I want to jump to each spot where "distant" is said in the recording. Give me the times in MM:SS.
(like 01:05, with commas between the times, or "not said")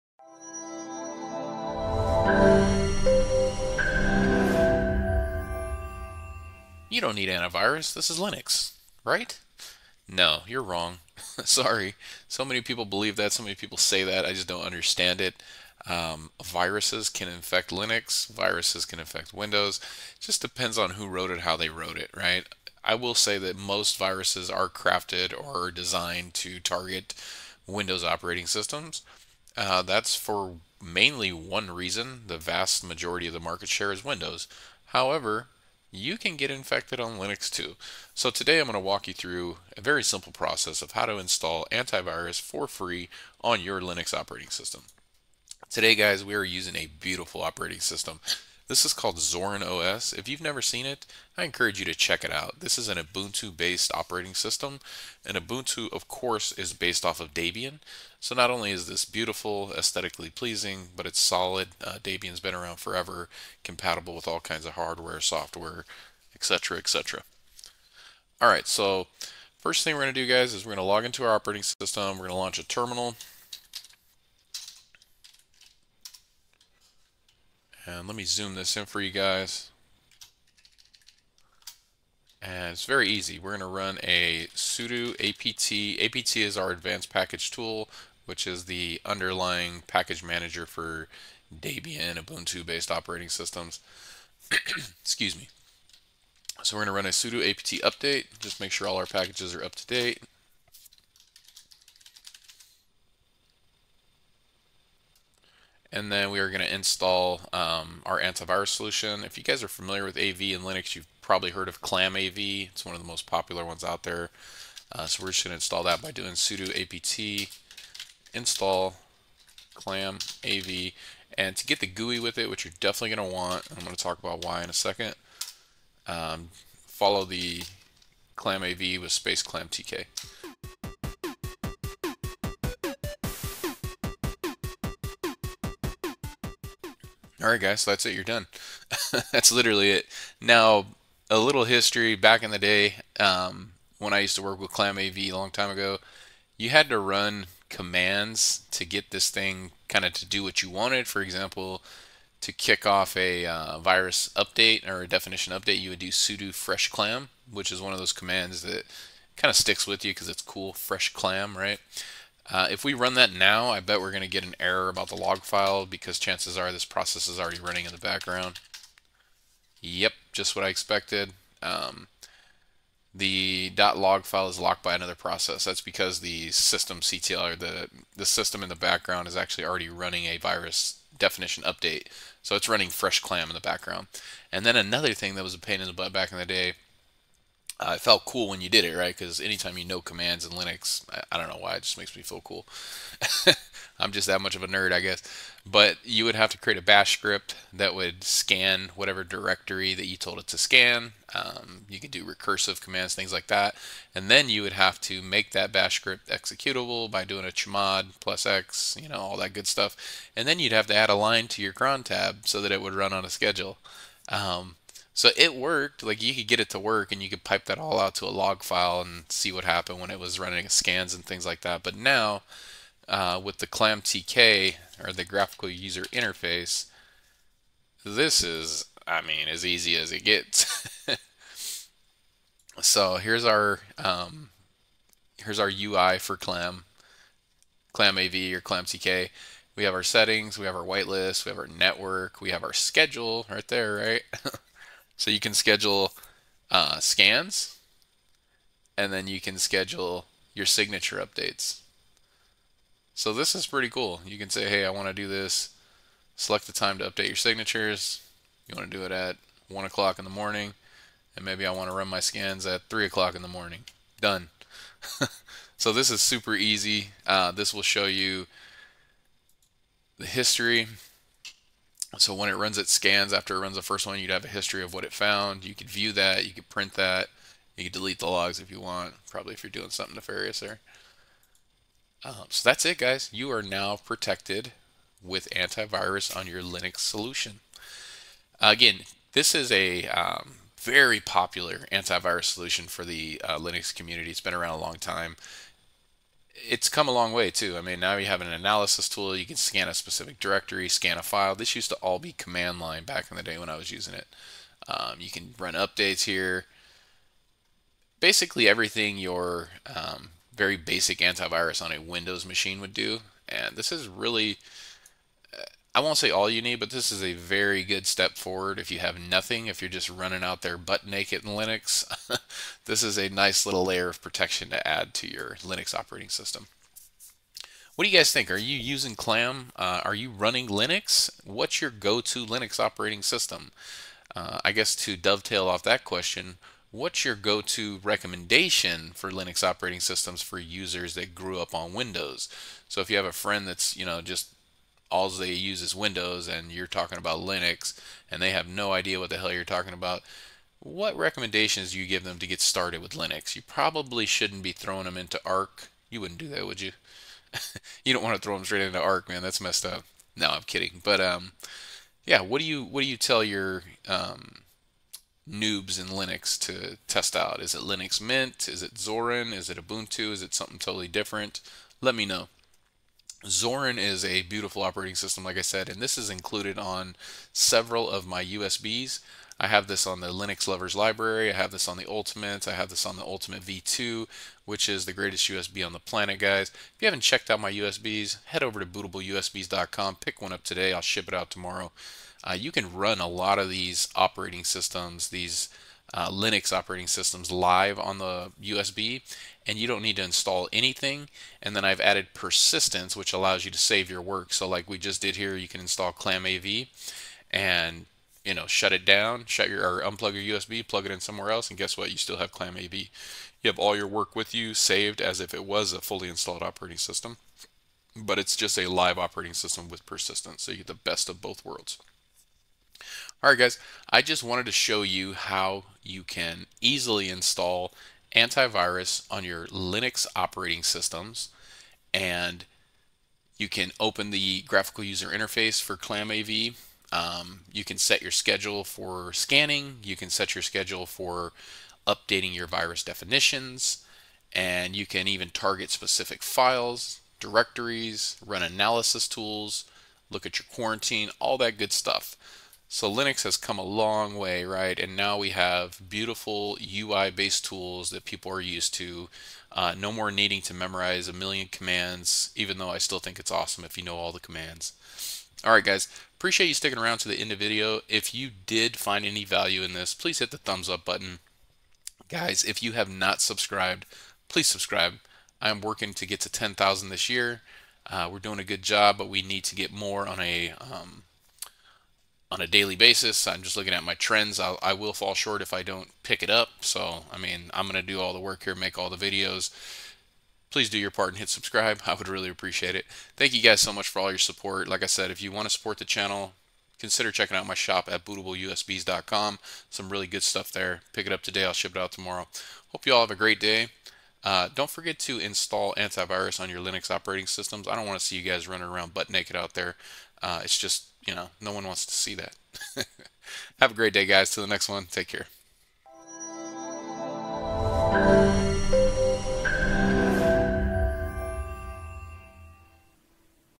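not said.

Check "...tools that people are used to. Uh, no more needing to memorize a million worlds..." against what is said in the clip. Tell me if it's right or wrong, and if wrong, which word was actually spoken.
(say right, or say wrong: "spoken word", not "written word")
wrong: "commands", not "worlds".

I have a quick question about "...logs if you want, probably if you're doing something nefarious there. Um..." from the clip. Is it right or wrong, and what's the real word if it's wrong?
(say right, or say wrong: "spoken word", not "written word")
right.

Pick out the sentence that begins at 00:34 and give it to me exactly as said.
However, you can get infected on Linux too.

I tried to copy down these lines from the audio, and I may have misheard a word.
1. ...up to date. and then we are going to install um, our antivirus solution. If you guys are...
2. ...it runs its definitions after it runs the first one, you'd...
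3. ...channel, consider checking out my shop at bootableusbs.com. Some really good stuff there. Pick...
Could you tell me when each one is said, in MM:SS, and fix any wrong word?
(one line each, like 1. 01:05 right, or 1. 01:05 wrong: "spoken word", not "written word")
1. 01:39 right
2. 04:32 wrong: "scans", not "definitions"
3. 08:16 right.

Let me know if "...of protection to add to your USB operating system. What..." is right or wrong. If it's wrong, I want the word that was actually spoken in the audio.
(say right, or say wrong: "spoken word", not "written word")
wrong: "Linux", not "USB".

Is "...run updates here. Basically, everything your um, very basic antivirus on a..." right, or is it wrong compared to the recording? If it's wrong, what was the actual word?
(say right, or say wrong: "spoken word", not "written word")
right.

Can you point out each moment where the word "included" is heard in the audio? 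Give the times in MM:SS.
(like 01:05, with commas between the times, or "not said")
06:16.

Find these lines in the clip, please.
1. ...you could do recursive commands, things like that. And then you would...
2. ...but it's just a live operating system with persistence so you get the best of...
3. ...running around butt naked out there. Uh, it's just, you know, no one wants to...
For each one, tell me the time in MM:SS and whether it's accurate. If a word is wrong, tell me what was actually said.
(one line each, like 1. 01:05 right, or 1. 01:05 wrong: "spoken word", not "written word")
1. 03:21 right
2. 06:58 right
3. 08:28 right.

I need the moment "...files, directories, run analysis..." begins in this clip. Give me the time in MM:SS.
07:26.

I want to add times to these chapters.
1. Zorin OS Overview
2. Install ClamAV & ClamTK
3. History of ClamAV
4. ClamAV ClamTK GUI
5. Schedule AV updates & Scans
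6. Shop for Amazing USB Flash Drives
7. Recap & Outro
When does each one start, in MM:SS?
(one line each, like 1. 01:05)
1. 00:45
2. 01:07
3. 02:19
4. 03:41
5. 04:01
6. 06:15
7. 07:02.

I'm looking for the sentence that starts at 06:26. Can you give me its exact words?
If you haven't checked out my USBs, head over to bootableusbs.com, pick one up today, I'll ship it out tomorrow.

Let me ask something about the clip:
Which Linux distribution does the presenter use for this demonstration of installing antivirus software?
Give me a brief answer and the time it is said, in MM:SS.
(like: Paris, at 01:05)
Zorin OS, at 00:49.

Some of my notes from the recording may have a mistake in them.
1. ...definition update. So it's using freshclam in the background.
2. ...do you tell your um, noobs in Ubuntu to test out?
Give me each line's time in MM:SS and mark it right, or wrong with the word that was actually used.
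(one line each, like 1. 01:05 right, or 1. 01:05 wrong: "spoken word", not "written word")
1. 03:01 wrong: "running", not "using"
2. 06:03 wrong: "Linux", not "Ubuntu".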